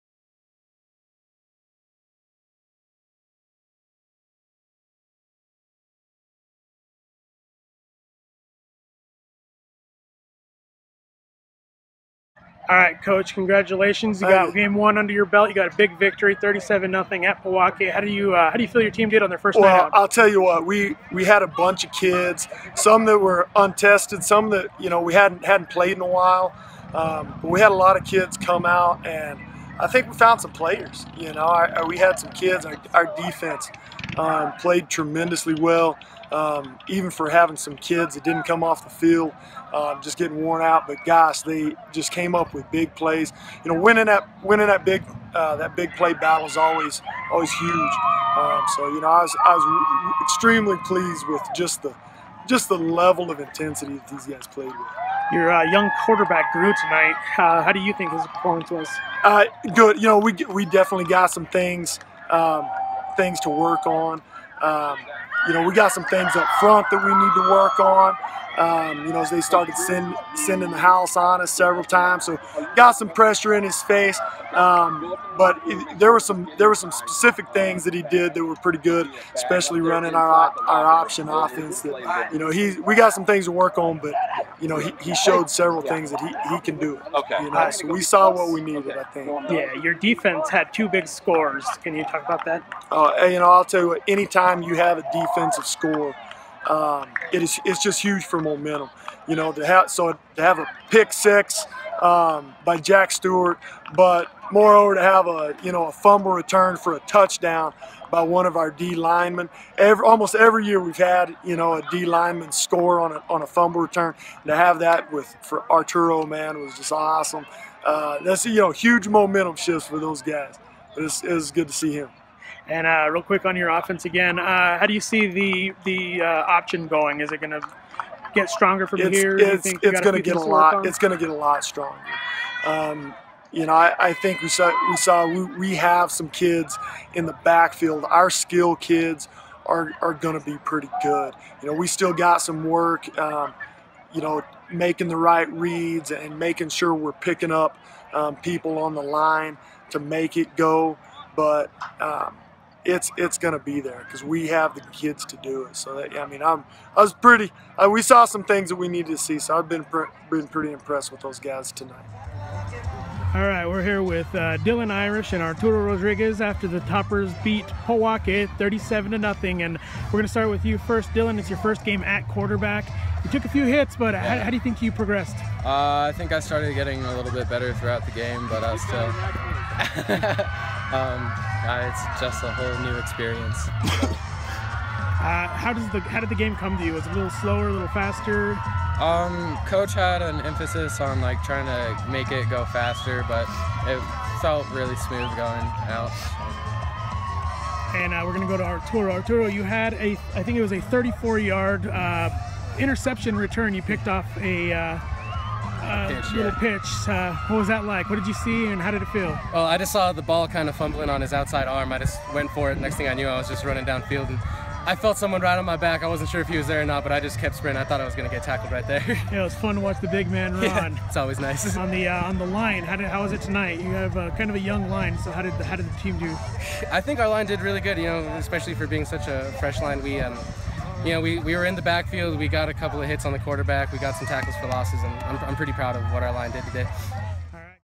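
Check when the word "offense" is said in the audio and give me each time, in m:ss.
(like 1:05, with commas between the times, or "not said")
1:21, 2:03.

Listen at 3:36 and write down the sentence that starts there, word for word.
I wasn't sure if he was there or not, but I just kept sprinting.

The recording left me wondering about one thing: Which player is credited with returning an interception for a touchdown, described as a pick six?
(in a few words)
Jack Stewart.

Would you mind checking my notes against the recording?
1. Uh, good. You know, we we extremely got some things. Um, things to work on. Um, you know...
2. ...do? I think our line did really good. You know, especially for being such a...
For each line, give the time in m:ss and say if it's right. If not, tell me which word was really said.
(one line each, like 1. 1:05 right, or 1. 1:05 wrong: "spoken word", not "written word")
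1. 0:59 wrong: "definitely", not "extremely"
2. 3:46 right.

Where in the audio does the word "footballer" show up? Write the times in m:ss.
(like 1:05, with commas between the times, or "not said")
not said.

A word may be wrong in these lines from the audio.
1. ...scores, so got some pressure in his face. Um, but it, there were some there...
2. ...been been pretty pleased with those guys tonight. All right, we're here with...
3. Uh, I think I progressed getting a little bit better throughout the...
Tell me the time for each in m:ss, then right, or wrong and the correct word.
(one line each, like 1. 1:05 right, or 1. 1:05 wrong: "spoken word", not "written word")
1. 1:11 wrong: "times", not "scores"
2. 2:39 wrong: "impressed", not "pleased"
3. 2:55 wrong: "started", not "progressed".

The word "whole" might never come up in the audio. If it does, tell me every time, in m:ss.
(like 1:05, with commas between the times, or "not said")
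3:02.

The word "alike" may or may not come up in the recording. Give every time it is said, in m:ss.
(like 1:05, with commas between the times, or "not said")
not said.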